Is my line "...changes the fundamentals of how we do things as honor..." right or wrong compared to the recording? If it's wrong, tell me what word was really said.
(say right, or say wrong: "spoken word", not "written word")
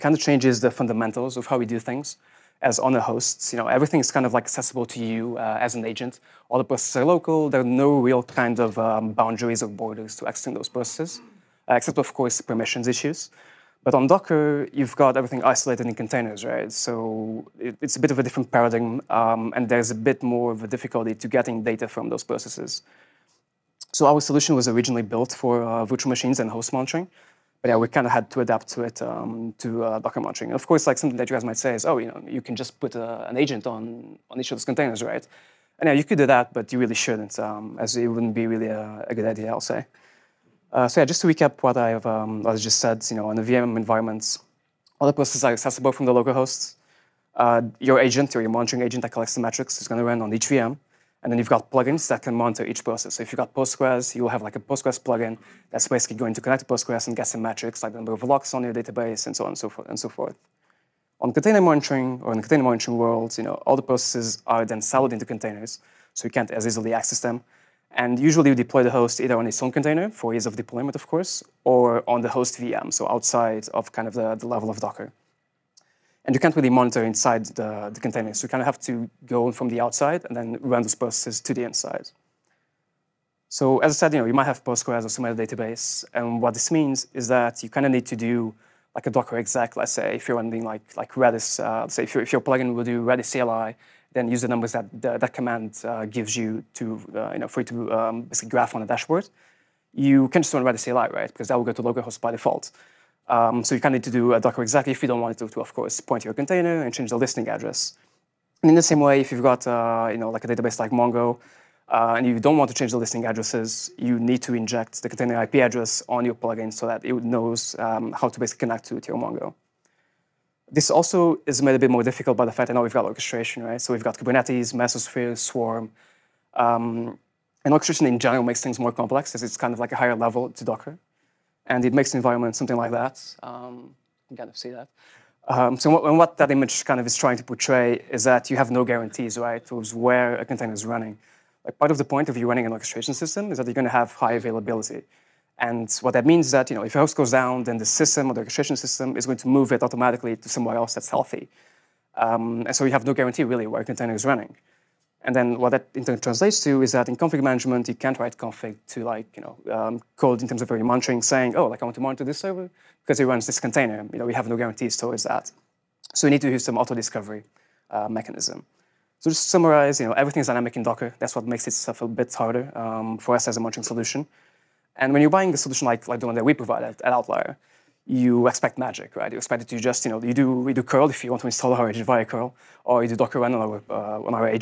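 right.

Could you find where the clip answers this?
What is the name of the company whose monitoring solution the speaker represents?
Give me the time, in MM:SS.
02:57.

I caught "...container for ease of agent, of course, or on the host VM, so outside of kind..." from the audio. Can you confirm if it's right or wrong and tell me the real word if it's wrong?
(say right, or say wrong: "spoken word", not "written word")
wrong: "deployment", not "agent".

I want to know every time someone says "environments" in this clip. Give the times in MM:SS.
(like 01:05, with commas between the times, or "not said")
00:43, 02:12.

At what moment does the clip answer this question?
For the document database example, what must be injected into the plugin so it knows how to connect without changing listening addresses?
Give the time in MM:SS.
01:55.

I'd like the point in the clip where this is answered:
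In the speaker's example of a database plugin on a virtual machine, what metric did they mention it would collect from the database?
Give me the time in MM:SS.
00:57.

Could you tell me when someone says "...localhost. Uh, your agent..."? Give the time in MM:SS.
00:46.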